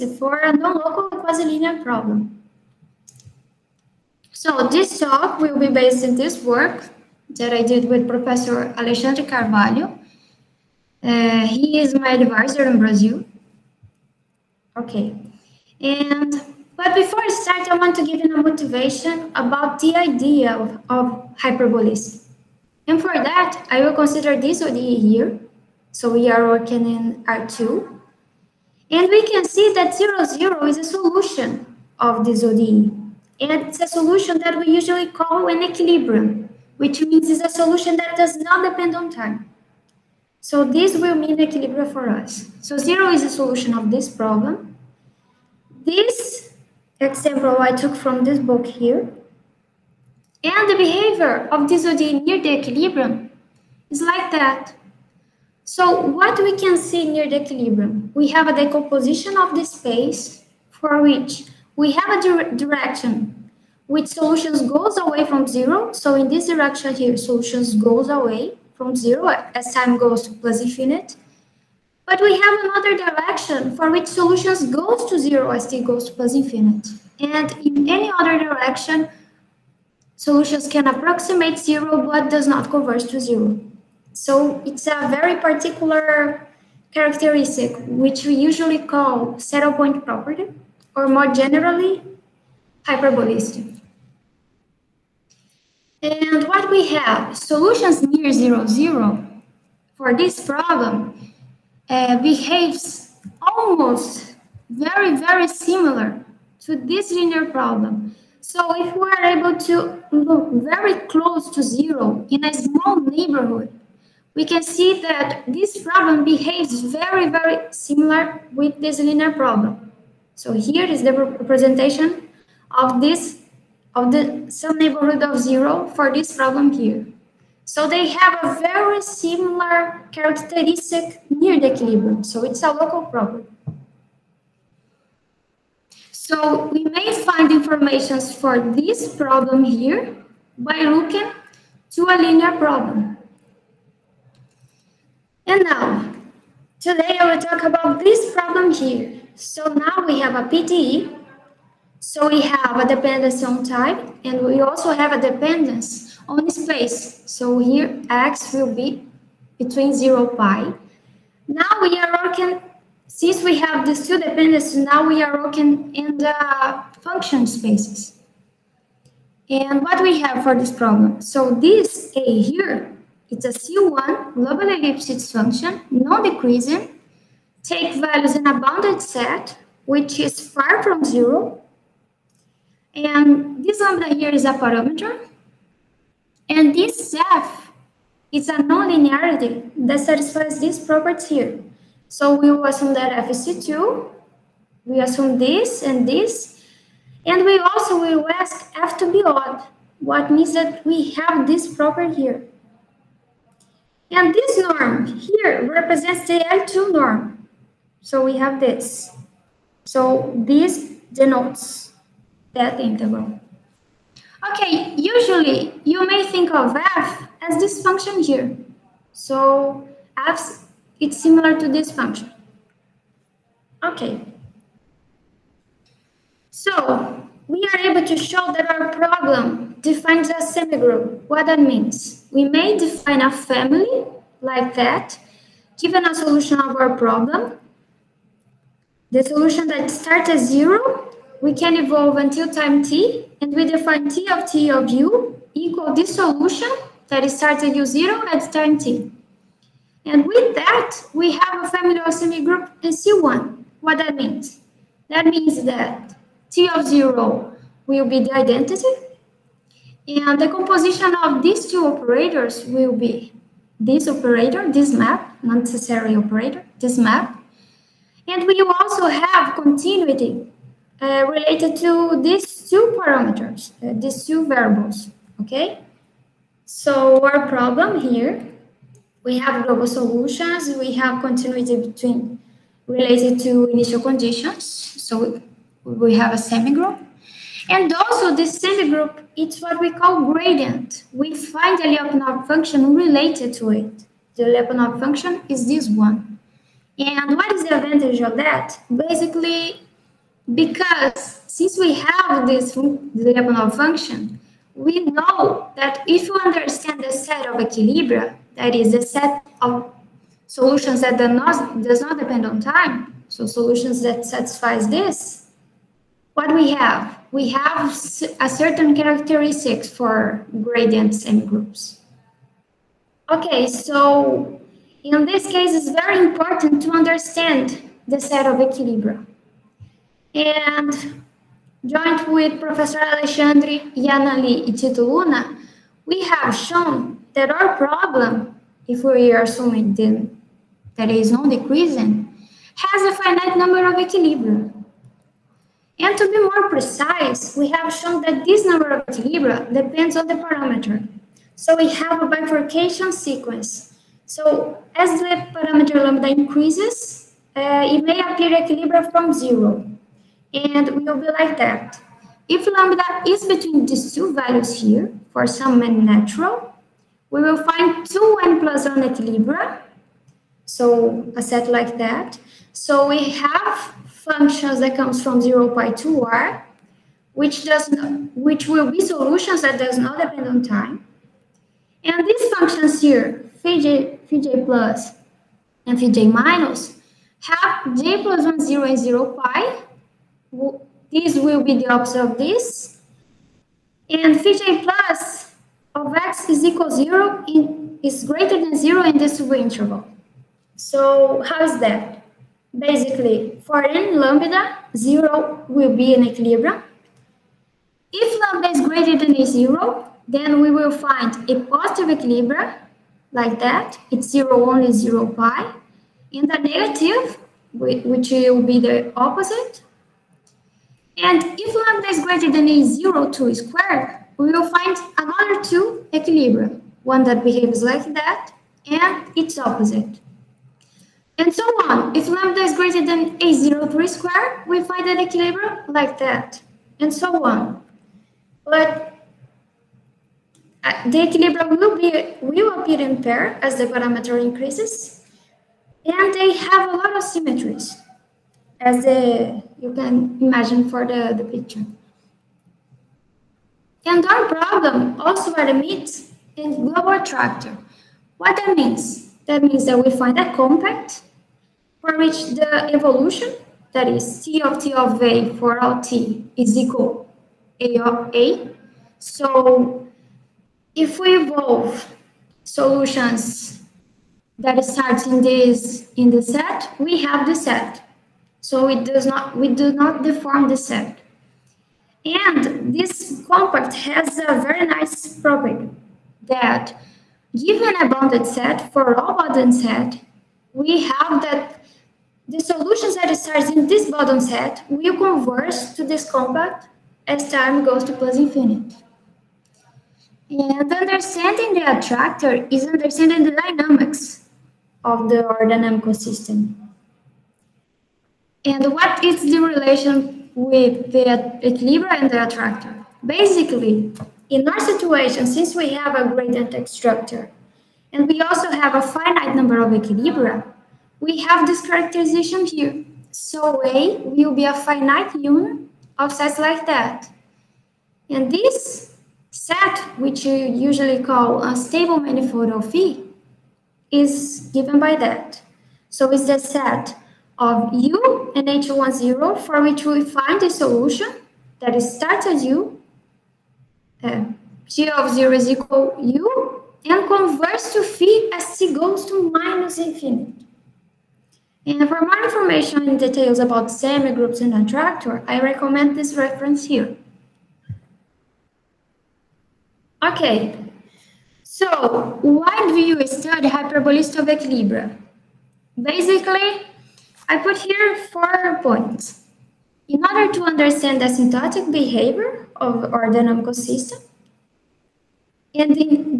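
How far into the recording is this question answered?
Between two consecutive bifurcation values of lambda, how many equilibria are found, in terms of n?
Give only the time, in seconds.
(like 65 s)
368 s.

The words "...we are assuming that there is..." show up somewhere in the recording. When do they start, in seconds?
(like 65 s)
339 s.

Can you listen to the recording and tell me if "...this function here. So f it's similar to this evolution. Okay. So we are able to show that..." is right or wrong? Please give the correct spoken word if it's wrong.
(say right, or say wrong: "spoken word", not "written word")
wrong: "function", not "evolution".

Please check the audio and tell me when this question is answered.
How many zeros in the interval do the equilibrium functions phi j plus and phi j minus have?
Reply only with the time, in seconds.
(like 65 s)
388 s.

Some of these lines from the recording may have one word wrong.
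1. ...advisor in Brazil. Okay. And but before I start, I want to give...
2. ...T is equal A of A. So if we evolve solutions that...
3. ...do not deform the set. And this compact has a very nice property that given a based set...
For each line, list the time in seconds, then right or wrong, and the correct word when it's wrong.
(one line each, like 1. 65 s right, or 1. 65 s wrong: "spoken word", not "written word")
1. 12 s right
2. 465 s right
3. 479 s wrong: "bounded", not "based".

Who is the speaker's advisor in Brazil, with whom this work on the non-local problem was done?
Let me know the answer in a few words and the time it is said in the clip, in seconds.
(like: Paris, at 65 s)
Alexandre Carvalho, at 8 s.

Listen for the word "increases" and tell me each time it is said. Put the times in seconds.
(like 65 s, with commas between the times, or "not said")
356 s, 444 s.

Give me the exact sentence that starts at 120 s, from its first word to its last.
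So here is the representation of this, of the some neighborhood of zero for this problem here.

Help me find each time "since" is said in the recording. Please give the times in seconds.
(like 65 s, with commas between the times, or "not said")
163 s, 301 s, 515 s.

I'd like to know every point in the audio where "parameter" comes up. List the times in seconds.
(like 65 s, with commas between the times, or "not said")
184 s, 272 s, 350 s, 355 s, 443 s.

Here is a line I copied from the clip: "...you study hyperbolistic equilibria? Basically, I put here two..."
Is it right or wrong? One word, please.
wrong.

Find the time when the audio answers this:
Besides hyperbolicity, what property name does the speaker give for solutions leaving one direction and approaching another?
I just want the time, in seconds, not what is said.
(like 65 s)
89 s.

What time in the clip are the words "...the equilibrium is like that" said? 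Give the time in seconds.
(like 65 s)
52 s.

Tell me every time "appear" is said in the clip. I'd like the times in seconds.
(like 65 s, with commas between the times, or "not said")
358 s, 442 s.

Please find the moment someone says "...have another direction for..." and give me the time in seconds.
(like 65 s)
72 s.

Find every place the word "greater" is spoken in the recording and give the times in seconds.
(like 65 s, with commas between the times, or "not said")
398 s, 408 s, 422 s, 432 s.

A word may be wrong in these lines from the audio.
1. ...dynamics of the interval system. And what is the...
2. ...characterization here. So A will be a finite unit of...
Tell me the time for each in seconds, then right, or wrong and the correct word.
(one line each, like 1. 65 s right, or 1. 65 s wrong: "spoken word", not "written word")
1. 503 s wrong: "dynamical", not "interval"
2. 521 s right.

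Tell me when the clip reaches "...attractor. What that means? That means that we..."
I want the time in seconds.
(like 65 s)
457 s.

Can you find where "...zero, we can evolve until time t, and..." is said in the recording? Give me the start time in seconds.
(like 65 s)
240 s.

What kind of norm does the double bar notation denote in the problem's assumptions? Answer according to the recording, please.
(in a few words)
L2 norm.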